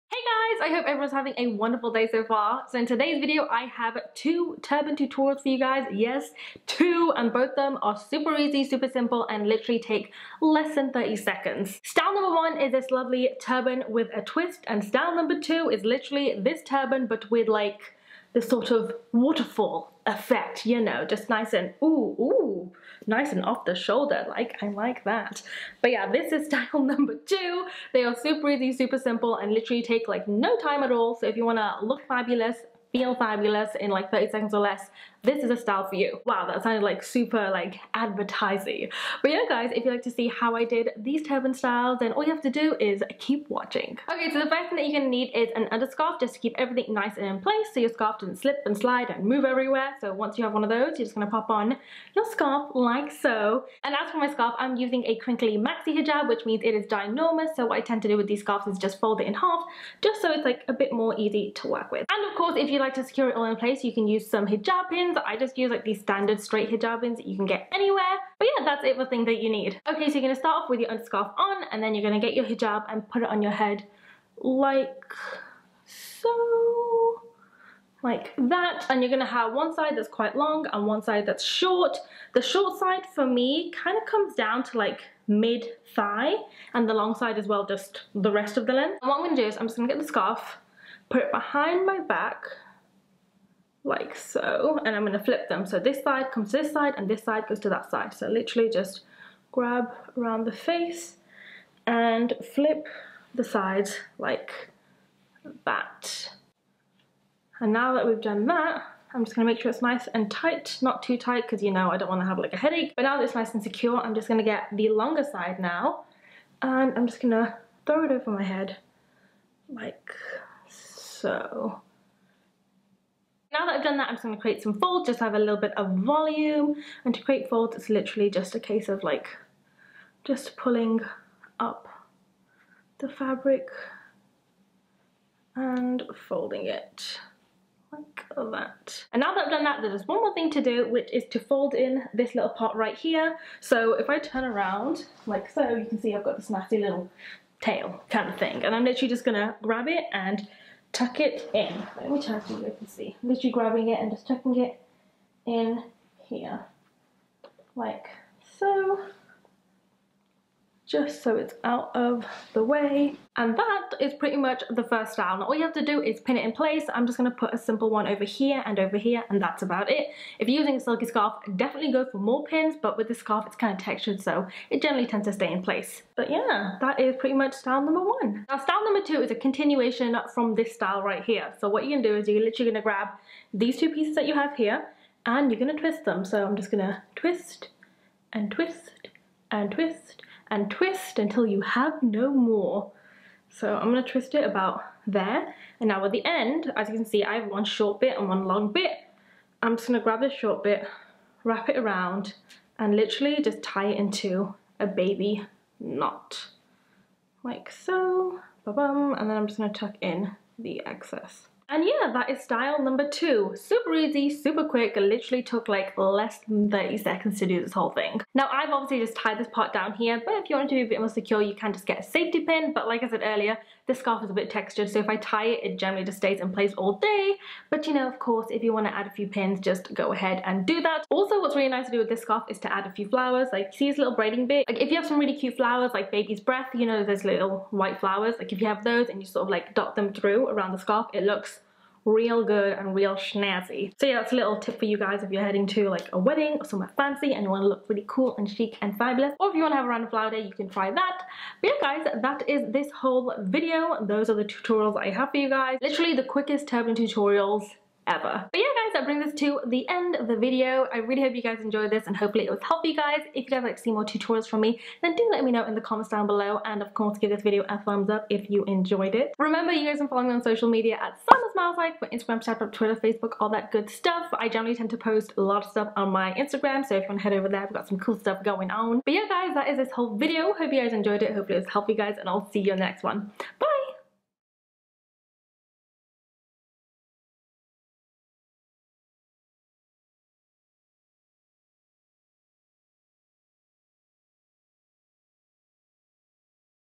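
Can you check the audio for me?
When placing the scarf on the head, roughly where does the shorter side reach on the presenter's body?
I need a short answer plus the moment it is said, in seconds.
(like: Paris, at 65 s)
mid thigh, at 85 s.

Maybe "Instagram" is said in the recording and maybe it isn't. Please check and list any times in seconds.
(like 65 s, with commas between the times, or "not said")
272 s, 276 s.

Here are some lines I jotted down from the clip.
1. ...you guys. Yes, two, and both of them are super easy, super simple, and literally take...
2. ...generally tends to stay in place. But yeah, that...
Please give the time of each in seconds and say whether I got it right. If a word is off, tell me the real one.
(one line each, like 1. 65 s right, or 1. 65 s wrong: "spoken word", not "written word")
1. 5 s right
2. 174 s right.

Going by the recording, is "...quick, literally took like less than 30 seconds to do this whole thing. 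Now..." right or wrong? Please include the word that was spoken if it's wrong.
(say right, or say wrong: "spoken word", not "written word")
right.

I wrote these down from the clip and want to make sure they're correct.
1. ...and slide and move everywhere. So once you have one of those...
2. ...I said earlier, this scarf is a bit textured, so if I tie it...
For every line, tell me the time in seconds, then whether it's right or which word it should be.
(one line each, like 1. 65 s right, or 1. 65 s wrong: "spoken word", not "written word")
1. 48 s right
2. 223 s right.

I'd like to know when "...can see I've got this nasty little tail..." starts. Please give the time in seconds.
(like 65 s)
145 s.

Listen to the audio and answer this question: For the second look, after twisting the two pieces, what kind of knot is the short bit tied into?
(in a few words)
baby knot.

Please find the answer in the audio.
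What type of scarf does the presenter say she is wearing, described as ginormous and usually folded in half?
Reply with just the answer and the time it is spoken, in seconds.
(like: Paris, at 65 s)
crinkly maxi hijab, at 55 s.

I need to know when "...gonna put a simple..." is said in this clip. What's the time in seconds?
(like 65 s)
167 s.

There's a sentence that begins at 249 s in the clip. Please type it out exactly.
Or if you want to have a random flower day, you can try that.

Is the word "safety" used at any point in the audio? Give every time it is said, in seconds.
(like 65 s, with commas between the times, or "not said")
222 s.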